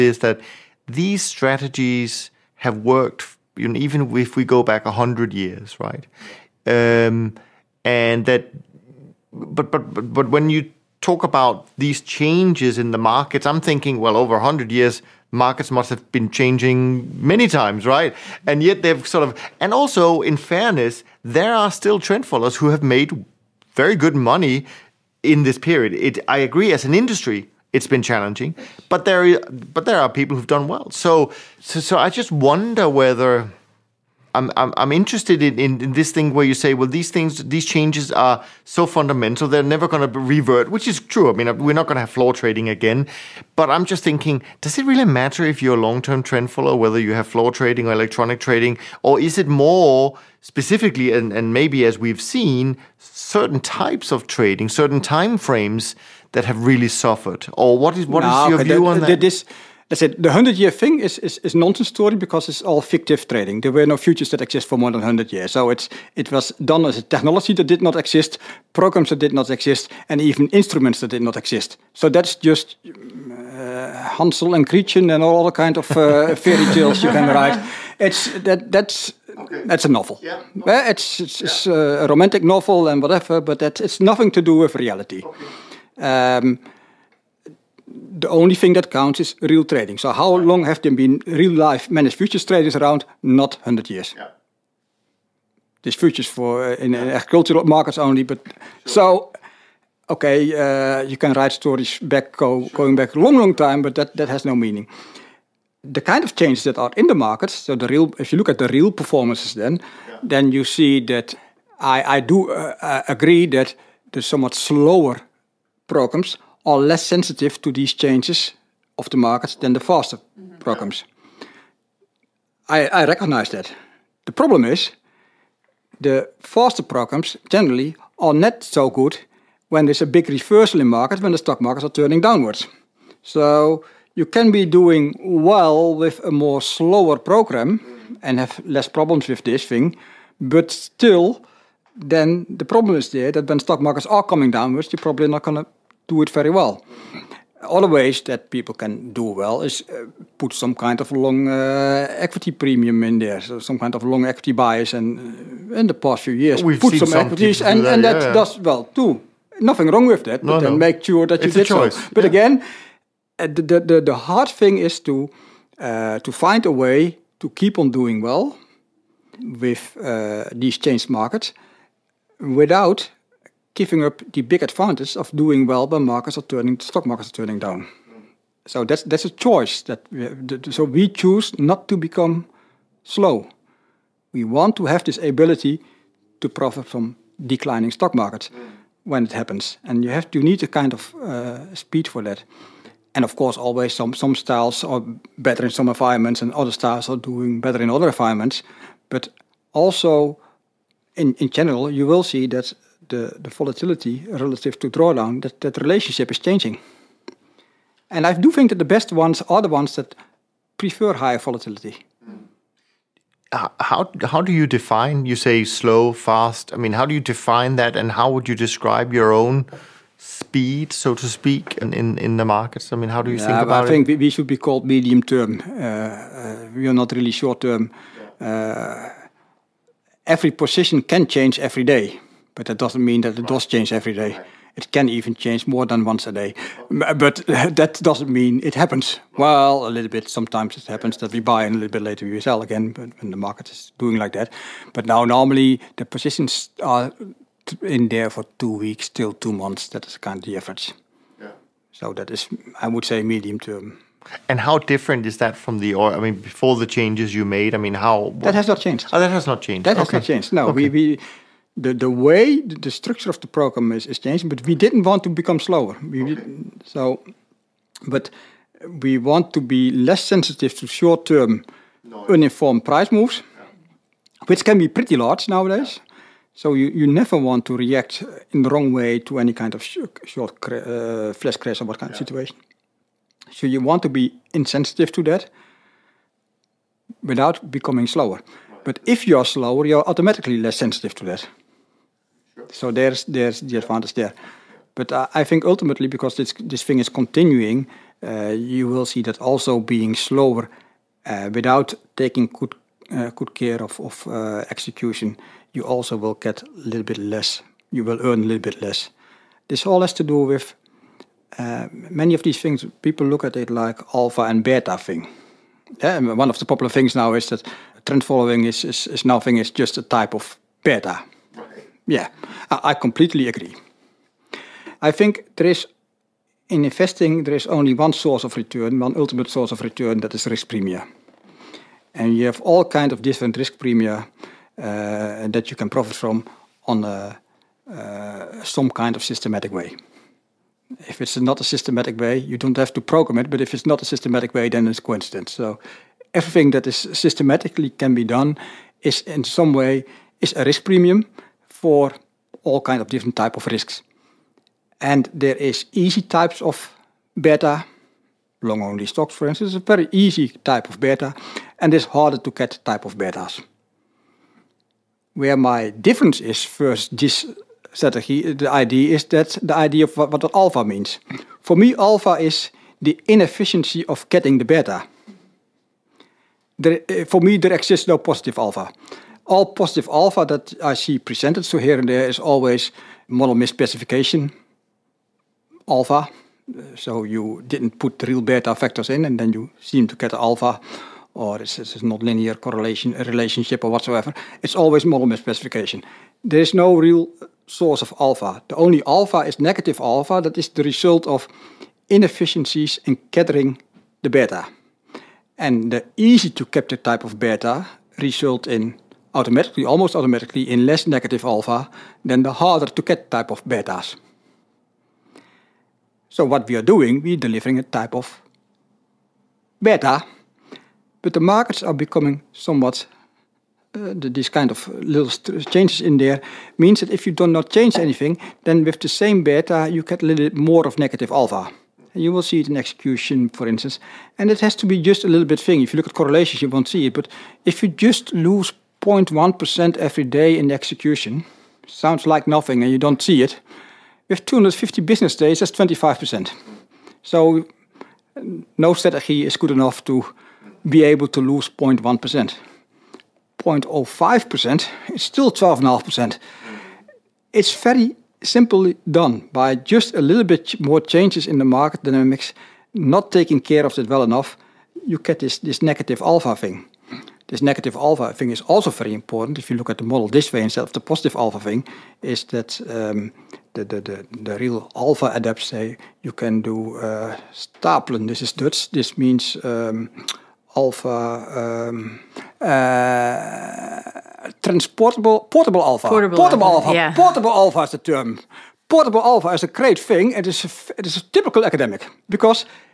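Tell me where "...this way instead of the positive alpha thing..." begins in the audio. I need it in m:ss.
7:50.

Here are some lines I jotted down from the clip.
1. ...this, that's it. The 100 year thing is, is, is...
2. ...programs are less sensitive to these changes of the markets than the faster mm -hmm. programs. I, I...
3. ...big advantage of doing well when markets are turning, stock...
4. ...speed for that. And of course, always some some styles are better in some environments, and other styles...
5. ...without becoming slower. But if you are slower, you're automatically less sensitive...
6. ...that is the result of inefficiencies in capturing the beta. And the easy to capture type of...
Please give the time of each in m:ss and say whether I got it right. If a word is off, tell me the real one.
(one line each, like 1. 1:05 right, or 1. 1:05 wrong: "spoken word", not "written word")
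1. 0:59 right
2. 1:55 right
3. 2:54 right
4. 3:11 right
5. 4:47 right
6. 6:40 right.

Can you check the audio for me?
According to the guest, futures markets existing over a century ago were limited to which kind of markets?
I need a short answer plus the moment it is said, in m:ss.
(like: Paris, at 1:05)
Agricultural markets, at 1:37.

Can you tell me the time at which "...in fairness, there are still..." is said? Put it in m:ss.
0:20.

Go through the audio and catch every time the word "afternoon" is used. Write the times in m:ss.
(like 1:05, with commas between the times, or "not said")
not said.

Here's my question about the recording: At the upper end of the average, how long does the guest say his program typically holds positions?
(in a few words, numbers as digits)
Two months.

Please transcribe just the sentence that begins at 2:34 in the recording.
And uh, in the past few years, We've put some, some equities, and, that, and that yeah, yeah.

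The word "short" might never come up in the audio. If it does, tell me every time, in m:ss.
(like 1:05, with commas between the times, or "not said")
3:47, 4:30, 4:40.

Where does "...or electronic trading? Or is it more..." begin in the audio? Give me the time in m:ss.
0:47.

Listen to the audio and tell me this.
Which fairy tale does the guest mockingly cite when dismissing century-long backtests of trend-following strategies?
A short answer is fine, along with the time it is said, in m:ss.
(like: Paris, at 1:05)
Hansel and Gretchen, at 1:14.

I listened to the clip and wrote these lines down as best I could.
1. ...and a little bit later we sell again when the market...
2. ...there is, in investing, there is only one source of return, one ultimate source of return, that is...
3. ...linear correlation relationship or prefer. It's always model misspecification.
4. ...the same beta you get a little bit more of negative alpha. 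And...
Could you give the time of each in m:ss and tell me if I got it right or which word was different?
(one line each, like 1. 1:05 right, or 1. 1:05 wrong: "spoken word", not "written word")
1. 4:01 right
2. 5:25 right
3. 6:32 wrong: "whatsoever", not "prefer"
4. 7:08 right.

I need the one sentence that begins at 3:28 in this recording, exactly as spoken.
And I do think that the best ones are the ones that prefer higher volatility.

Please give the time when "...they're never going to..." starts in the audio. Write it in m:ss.
0:39.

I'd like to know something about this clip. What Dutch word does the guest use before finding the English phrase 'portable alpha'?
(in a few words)
stapelen.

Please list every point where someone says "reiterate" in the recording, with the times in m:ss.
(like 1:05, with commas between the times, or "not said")
not said.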